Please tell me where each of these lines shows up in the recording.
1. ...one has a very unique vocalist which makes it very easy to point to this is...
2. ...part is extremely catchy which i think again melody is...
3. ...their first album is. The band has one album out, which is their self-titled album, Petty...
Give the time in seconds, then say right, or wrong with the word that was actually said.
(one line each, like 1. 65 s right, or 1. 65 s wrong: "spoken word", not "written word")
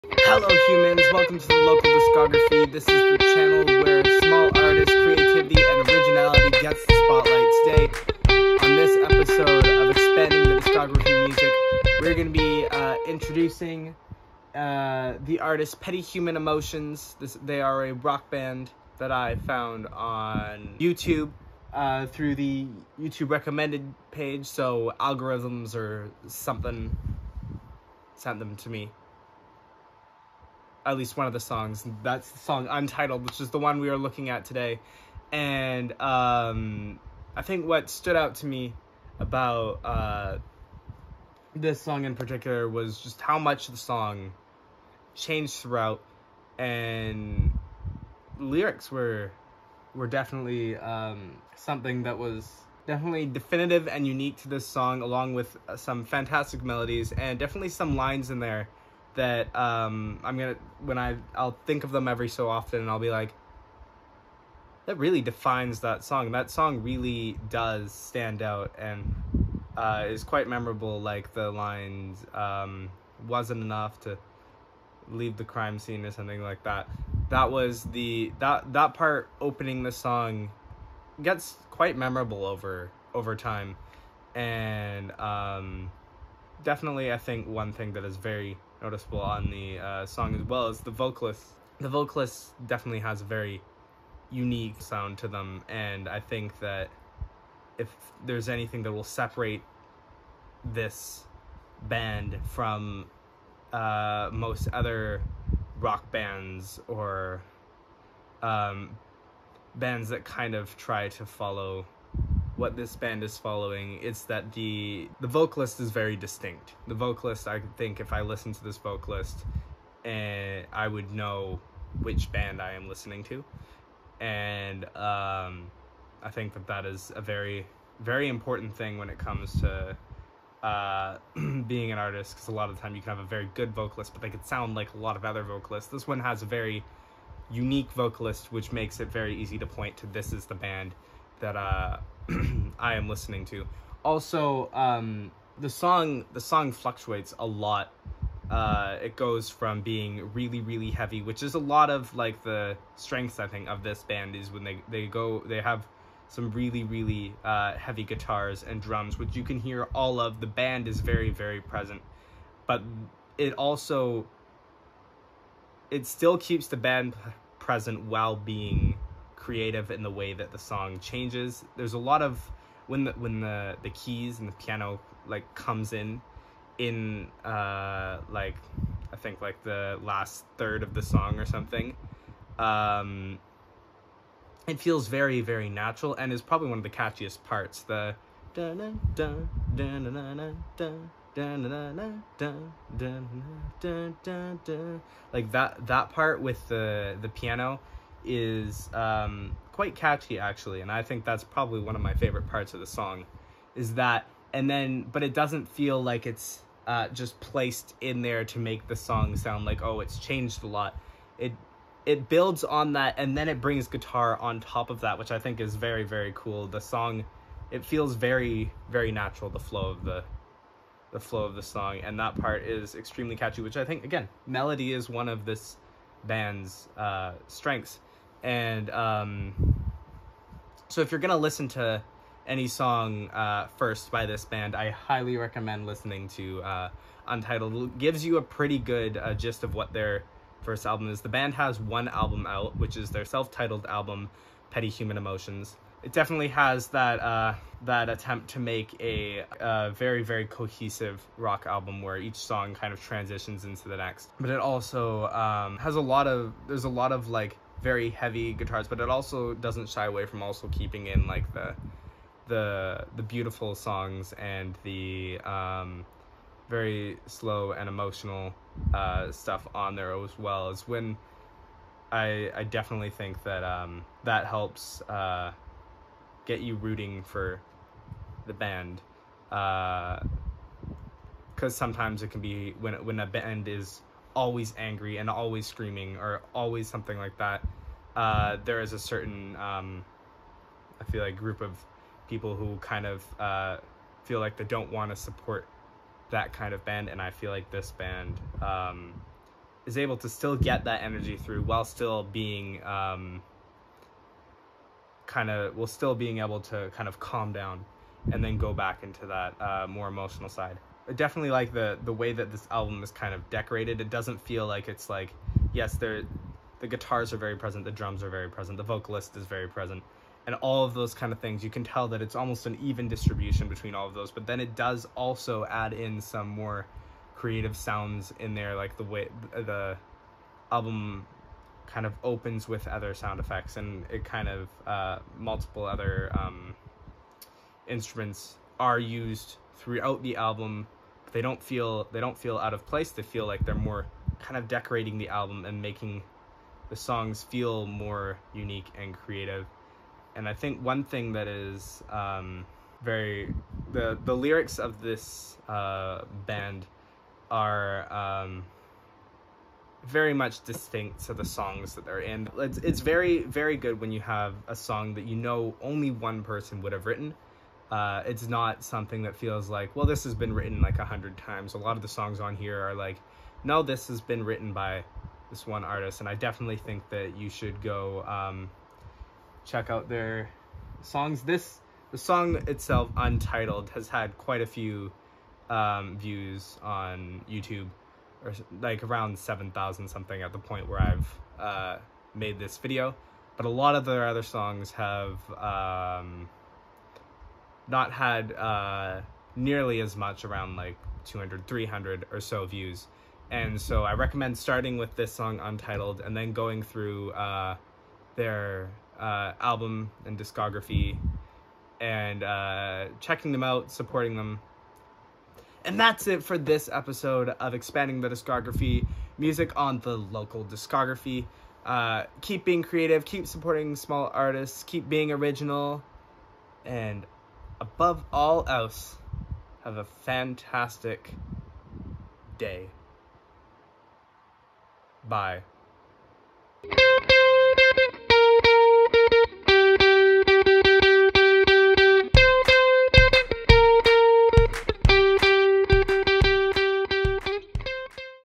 1. 136 s right
2. 222 s right
3. 239 s right.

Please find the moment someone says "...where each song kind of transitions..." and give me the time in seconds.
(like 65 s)
252 s.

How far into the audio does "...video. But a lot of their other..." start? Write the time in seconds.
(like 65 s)
392 s.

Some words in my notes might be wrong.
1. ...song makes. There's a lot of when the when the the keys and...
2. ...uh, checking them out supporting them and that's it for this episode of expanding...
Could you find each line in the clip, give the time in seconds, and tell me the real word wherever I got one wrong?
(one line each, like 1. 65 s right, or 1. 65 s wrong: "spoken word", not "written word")
1. 170 s wrong: "changes", not "makes"
2. 412 s right.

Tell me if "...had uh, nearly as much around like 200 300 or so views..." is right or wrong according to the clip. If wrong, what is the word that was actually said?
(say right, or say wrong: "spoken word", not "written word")
right.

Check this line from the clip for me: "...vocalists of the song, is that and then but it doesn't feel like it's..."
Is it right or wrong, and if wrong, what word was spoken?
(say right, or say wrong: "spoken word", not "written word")
wrong: "parts", not "vocalists".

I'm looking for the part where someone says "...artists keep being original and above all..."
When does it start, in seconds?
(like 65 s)
424 s.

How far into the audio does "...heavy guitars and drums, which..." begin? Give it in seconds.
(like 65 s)
157 s.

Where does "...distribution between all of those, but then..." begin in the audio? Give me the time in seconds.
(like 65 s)
323 s.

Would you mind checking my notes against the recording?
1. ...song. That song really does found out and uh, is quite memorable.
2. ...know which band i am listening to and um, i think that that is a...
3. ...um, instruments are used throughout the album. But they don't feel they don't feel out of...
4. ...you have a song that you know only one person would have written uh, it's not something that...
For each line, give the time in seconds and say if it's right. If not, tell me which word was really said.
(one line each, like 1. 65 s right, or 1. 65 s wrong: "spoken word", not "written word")
1. 66 s wrong: "stand", not "found"
2. 121 s right
3. 336 s right
4. 364 s right.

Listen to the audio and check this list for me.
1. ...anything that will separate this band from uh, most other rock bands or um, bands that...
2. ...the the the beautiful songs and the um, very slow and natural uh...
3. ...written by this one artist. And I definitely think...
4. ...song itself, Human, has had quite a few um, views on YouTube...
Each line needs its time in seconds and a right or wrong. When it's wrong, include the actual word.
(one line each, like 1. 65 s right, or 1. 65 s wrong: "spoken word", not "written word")
1. 98 s right
2. 261 s wrong: "emotional", not "natural"
3. 374 s right
4. 382 s wrong: "Untitled", not "Human".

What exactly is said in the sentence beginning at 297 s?
And I feel like this band um, is able to still get that energy through while still being.